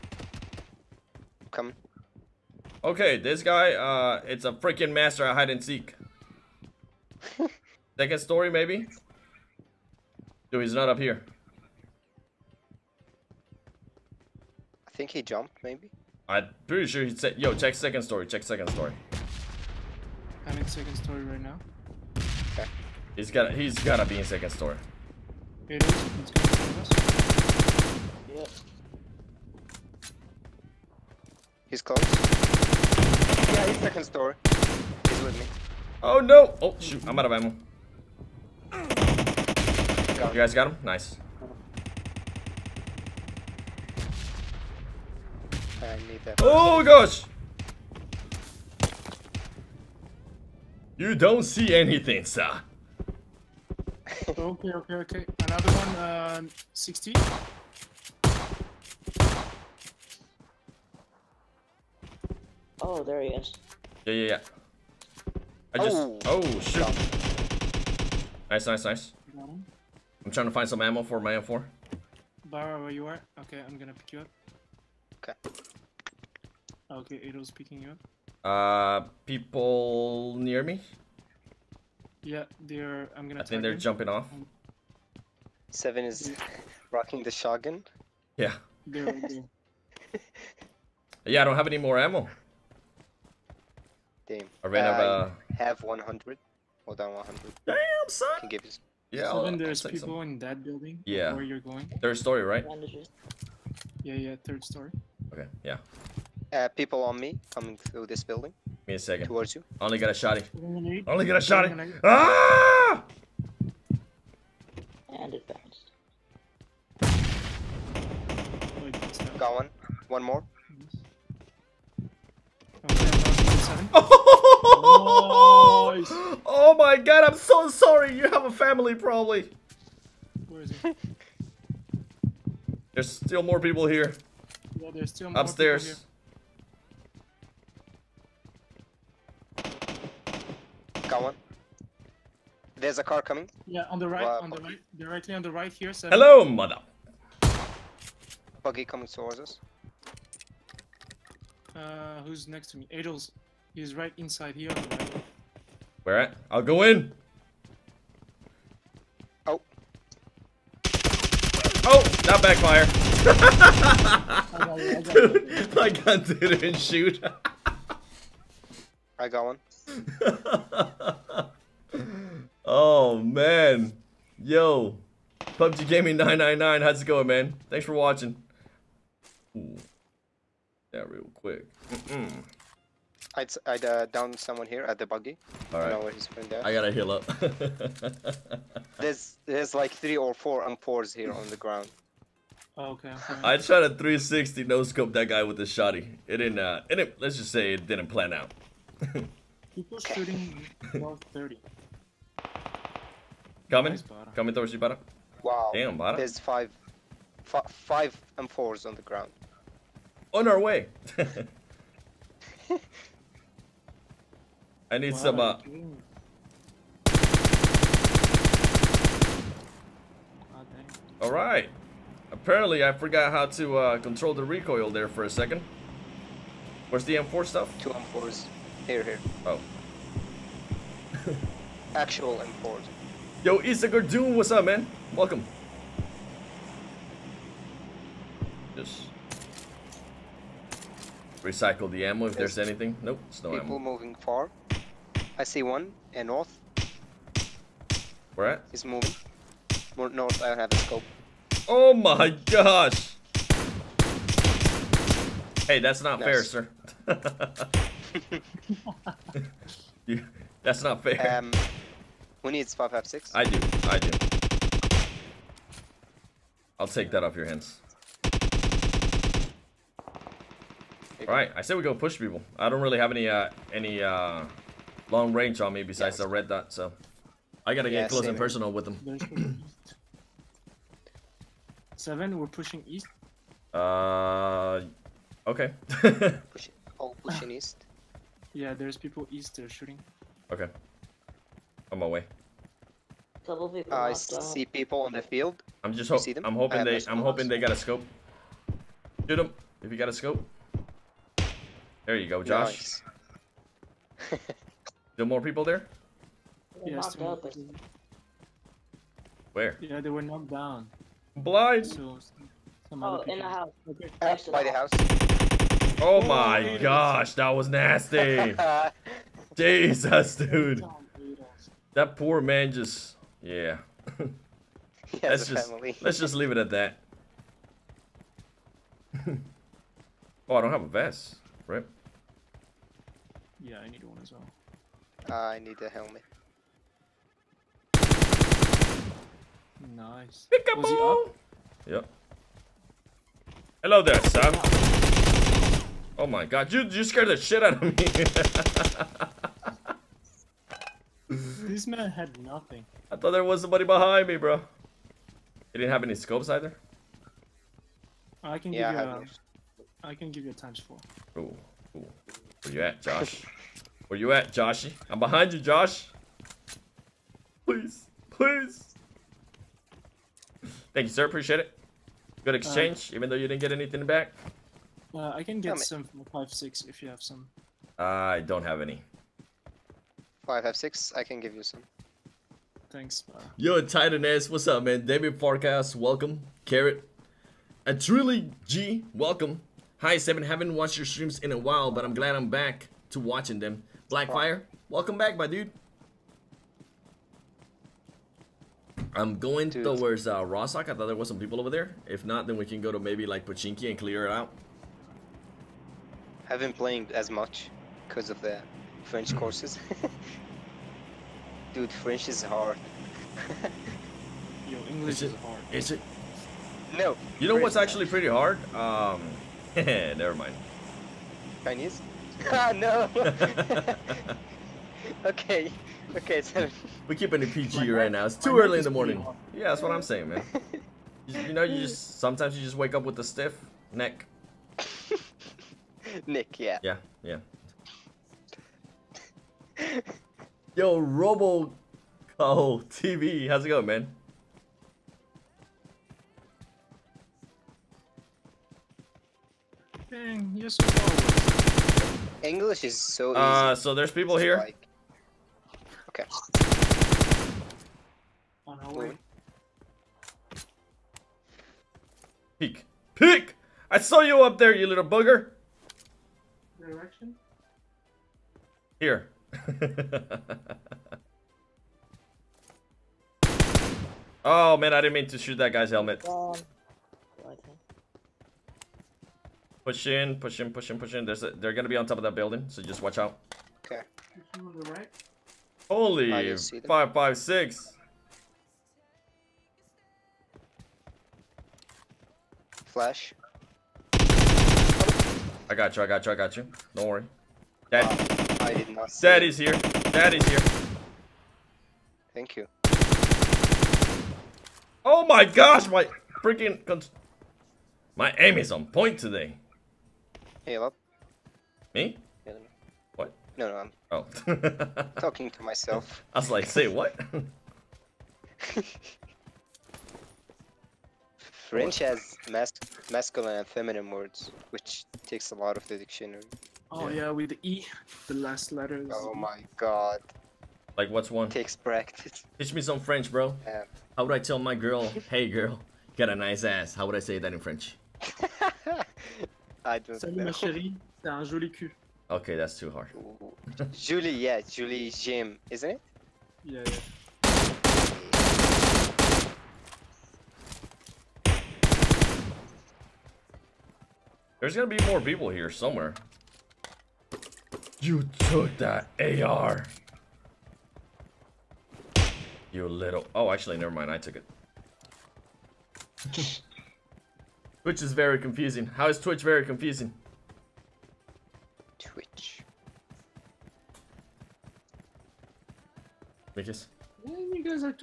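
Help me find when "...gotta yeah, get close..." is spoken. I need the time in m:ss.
4:37.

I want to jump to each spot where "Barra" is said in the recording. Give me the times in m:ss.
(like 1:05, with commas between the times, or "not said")
1:12.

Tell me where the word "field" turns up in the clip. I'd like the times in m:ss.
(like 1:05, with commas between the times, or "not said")
4:55.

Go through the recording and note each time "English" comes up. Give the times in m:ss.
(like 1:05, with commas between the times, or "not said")
6:54, 7:32.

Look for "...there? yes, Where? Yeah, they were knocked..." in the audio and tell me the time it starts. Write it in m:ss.
5:05.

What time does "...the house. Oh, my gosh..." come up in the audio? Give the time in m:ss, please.
5:14.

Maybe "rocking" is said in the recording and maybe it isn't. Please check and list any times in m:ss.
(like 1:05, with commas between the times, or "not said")
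1:26.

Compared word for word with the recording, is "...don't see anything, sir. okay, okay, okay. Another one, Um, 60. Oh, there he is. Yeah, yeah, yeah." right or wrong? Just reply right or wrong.
right.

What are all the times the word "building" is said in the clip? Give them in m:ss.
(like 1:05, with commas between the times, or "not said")
1:40, 1:48, 8:02.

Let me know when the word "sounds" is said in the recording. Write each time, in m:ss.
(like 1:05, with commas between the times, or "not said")
not said.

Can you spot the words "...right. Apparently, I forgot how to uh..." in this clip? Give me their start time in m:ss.
3:41.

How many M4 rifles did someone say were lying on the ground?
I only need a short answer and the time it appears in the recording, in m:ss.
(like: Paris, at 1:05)
5, at 3:27.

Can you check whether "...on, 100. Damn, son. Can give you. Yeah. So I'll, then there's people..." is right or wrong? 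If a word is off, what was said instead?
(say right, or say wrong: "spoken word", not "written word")
right.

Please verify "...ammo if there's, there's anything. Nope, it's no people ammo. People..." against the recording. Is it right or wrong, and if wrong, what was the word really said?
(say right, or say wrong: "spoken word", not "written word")
right.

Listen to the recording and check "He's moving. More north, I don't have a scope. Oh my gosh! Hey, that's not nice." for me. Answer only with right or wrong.
right.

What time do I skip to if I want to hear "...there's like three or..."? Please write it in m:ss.
3:09.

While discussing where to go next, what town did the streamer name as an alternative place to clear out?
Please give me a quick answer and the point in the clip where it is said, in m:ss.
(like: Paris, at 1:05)
Pachinki, at 6:43.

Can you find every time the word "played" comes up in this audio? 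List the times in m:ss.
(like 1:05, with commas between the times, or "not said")
6:46.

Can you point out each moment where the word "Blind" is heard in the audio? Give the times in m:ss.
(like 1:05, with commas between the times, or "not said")
5:11.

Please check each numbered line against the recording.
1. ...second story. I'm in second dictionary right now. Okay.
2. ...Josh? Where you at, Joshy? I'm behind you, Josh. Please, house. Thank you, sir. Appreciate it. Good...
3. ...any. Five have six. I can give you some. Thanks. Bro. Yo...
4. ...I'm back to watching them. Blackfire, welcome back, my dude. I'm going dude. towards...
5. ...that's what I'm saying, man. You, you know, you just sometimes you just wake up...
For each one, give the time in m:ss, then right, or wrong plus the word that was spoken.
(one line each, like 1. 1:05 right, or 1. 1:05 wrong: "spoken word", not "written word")
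1. 0:18 wrong: "story", not "dictionary"
2. 6:03 wrong: "please", not "house"
3. 6:18 right
4. 6:32 right
5. 7:09 right.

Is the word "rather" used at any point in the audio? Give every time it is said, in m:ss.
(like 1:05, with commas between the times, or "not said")
not said.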